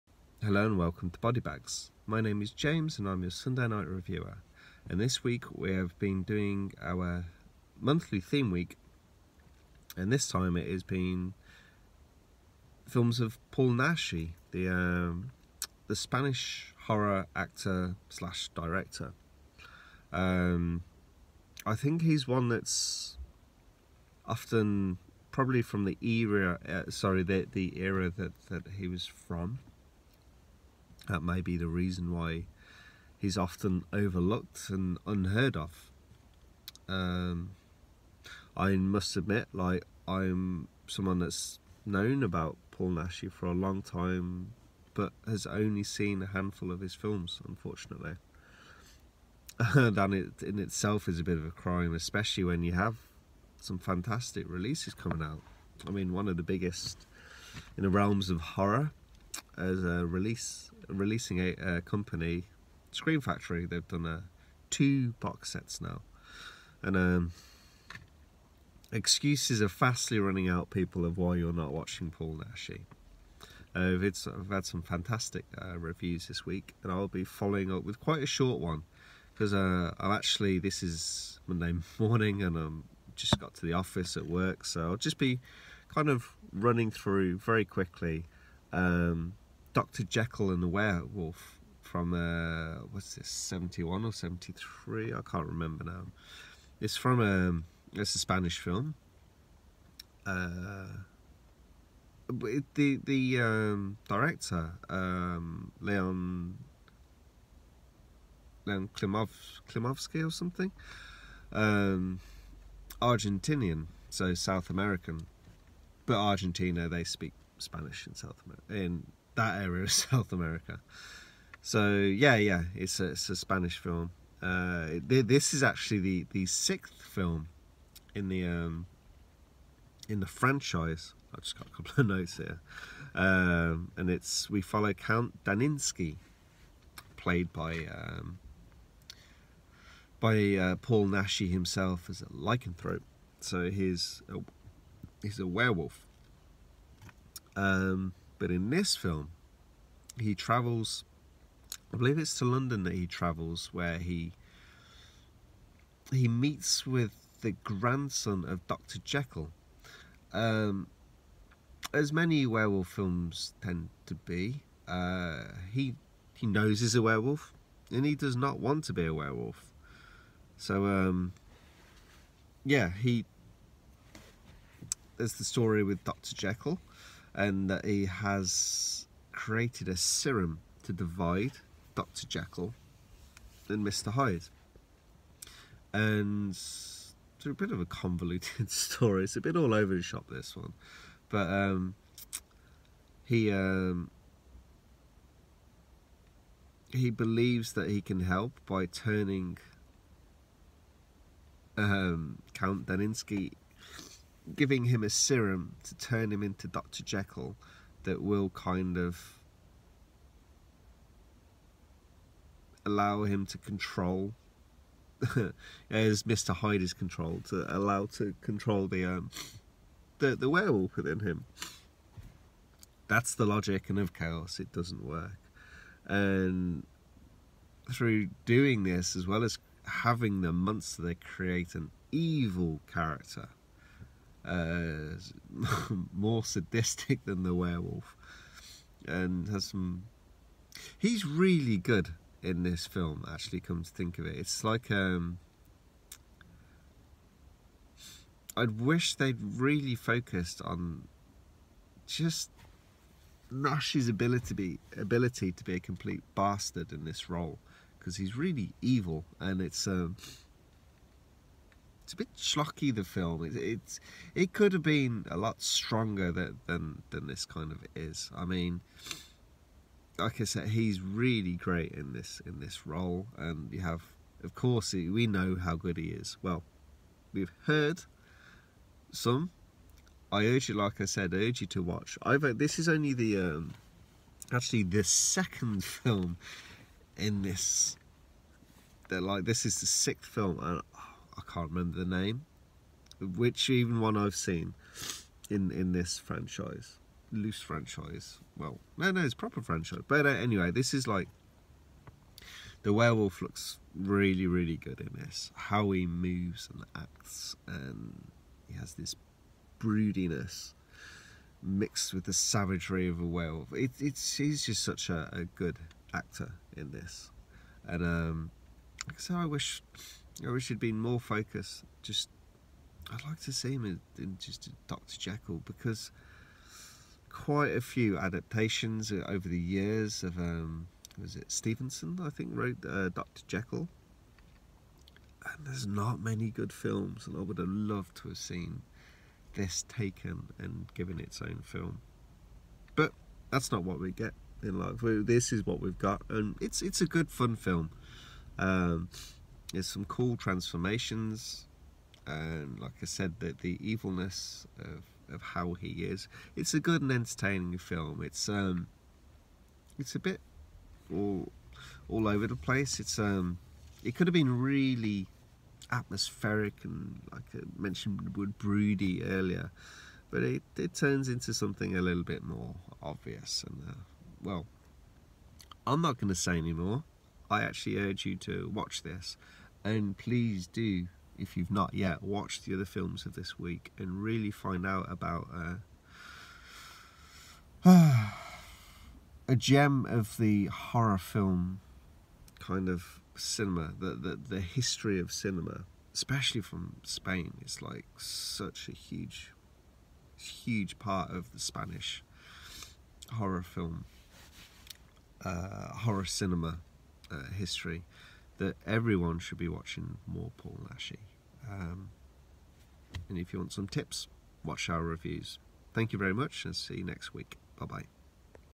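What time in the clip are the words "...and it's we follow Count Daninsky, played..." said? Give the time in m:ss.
2:13.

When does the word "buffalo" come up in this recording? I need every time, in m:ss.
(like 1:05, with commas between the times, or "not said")
not said.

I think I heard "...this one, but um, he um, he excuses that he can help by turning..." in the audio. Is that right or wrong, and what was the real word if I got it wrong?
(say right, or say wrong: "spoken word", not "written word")
wrong: "believes", not "excuses".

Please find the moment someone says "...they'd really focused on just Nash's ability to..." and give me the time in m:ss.
4:09.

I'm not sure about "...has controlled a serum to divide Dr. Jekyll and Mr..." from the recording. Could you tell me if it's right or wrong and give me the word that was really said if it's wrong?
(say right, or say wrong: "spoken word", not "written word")
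wrong: "created", not "controlled".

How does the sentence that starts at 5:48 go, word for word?
Um, there's some cool transformations, and um, like I said, the, the evilness of, of how he is.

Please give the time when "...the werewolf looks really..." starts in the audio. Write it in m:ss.
5:02.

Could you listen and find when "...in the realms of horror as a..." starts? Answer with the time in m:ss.
0:57.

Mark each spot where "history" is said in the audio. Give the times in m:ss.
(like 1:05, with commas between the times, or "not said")
6:34, 6:47.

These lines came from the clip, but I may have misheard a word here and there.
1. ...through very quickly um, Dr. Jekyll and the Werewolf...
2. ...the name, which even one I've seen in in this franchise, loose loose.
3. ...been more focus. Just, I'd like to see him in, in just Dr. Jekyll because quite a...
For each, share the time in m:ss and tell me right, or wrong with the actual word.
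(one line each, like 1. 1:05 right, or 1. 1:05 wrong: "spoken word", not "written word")
1. 1:26 right
2. 4:51 wrong: "franchise", not "loose"
3. 5:20 right.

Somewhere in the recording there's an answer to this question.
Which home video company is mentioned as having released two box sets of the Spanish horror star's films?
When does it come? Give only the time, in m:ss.
1:02.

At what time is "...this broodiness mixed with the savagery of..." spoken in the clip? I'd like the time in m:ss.
5:08.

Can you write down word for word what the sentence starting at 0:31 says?
That may be the reason why he's often overlooked and unheard of.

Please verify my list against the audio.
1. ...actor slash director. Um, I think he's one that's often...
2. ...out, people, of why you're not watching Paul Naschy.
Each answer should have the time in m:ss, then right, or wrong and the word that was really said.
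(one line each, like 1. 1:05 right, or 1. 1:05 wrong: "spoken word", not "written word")
1. 0:17 right
2. 1:10 right.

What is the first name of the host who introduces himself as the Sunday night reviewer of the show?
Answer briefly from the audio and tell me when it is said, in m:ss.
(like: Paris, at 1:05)
James, at 0:02.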